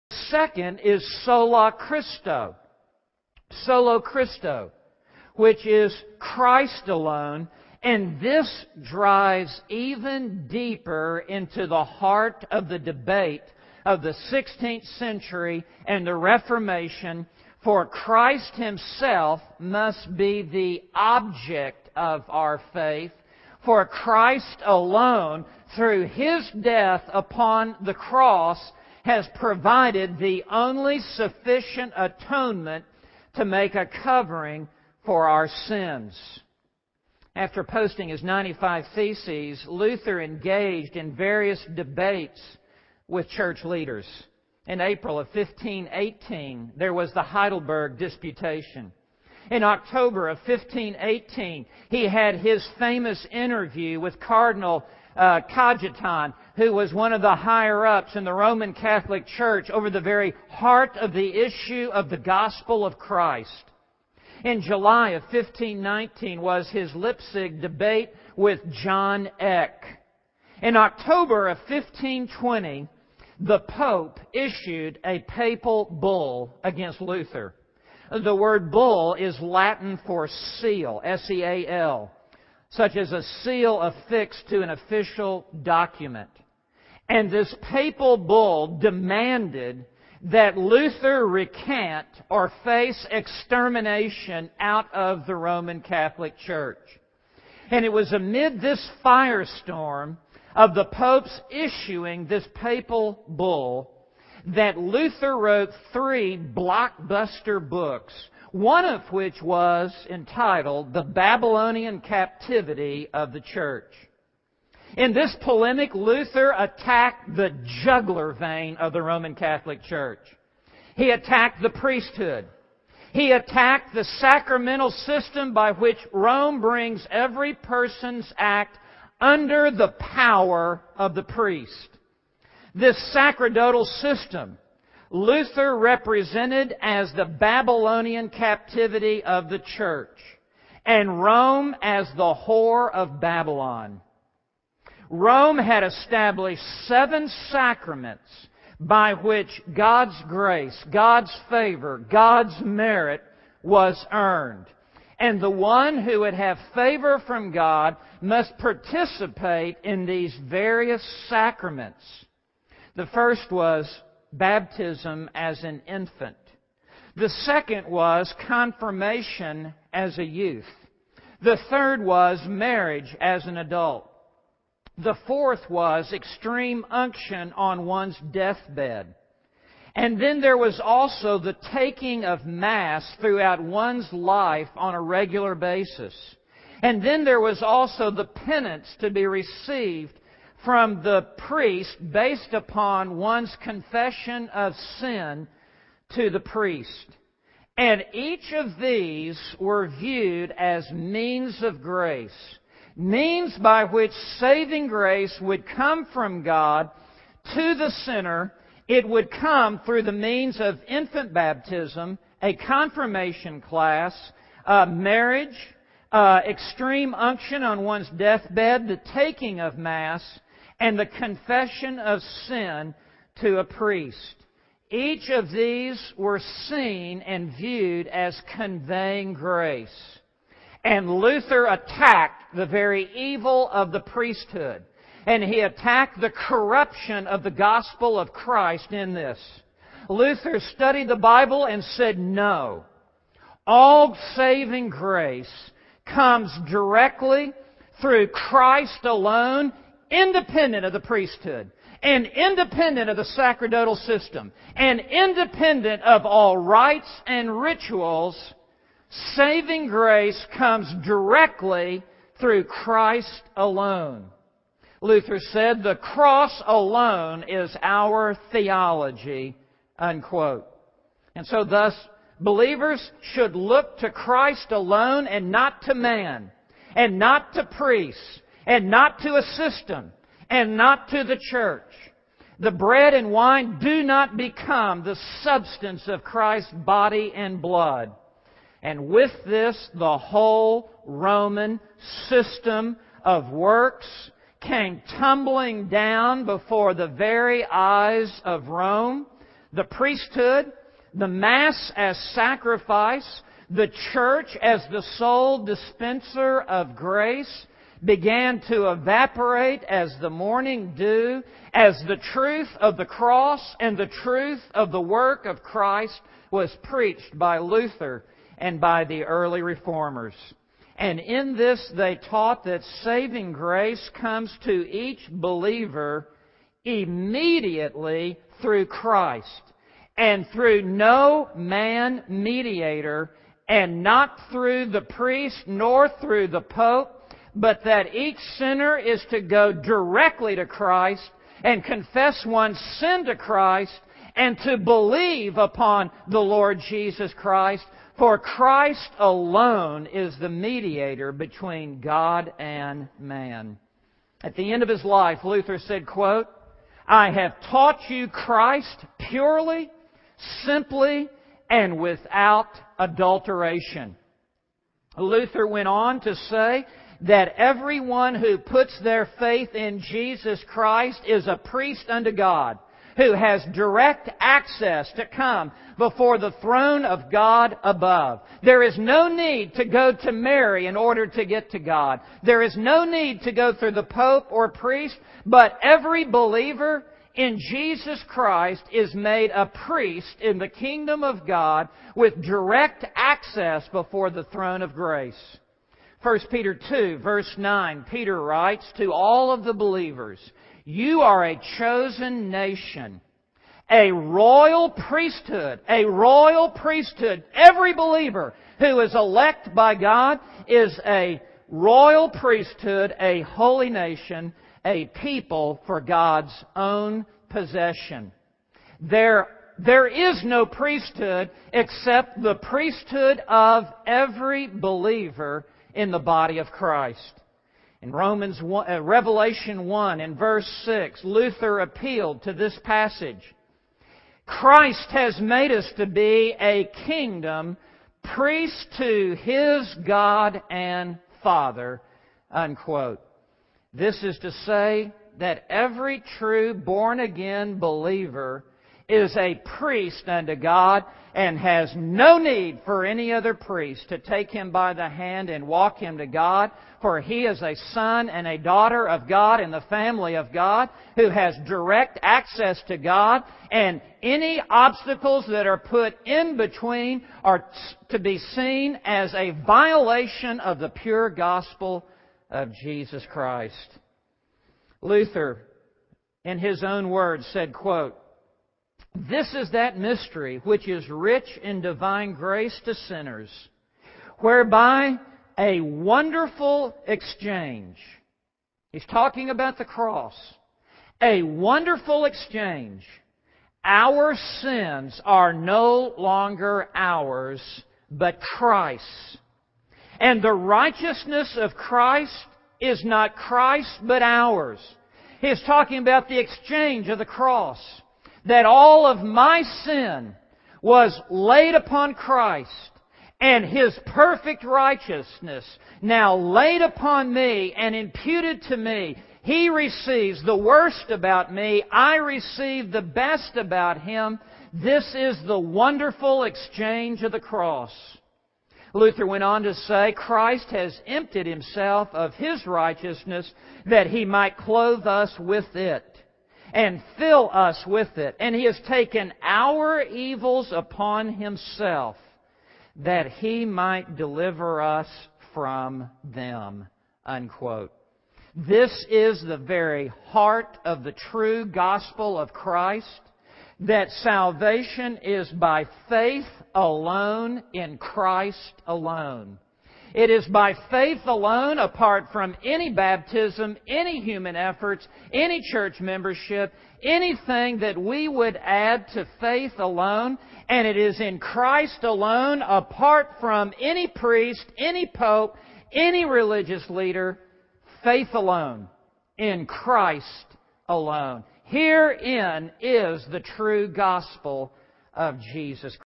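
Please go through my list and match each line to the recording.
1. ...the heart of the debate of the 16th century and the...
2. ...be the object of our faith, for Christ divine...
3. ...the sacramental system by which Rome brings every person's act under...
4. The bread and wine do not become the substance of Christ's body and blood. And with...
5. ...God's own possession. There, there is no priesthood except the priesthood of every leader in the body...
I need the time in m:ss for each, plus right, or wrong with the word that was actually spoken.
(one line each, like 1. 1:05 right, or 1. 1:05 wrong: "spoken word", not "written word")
1. 0:11 right
2. 0:20 wrong: "alone", not "divine"
3. 2:03 right
4. 4:42 right
5. 6:55 wrong: "believer", not "leader".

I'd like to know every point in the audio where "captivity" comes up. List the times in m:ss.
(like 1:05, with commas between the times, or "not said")
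1:52, 2:18.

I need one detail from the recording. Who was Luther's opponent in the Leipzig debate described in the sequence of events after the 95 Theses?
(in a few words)
John Eck.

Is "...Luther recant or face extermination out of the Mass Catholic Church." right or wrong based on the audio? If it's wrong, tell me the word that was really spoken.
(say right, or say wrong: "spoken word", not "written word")
wrong: "Roman", not "Mass".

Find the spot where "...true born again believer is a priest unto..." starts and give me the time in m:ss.
7:26.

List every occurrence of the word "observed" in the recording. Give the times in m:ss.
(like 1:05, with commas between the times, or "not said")
not said.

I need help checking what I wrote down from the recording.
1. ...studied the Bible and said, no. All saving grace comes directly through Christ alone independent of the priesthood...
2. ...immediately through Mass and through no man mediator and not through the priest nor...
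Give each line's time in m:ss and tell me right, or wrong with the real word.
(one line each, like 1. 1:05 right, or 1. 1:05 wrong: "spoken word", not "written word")
1. 4:00 right
2. 5:26 wrong: "Christ", not "Mass".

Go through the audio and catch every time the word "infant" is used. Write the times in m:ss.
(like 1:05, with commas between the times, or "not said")
2:45, 3:30.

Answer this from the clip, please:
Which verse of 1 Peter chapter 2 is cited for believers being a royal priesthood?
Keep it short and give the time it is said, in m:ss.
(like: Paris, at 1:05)
Verse 9, at 6:37.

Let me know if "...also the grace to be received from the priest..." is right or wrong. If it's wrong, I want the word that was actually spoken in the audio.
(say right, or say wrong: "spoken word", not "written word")
wrong: "penance", not "grace".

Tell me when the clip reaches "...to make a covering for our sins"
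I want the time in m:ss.
0:33.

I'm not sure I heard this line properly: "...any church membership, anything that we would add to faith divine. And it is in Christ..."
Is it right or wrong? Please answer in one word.
wrong.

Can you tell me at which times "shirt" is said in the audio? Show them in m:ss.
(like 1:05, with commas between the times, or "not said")
not said.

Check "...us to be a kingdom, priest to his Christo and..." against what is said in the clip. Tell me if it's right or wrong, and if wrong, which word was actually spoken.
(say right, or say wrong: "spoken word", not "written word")
wrong: "God", not "Christo".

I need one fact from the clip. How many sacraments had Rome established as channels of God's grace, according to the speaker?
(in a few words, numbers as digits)
7.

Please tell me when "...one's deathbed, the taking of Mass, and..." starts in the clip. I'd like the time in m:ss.
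3:37.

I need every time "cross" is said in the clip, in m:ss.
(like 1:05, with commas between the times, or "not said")
0:27, 4:25, 5:13, 8:09, 8:27, 8:47.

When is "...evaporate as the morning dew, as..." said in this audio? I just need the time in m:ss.
5:08.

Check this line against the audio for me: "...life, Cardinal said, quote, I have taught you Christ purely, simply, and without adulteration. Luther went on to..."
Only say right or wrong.
wrong.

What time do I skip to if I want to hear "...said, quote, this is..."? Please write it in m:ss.
7:57.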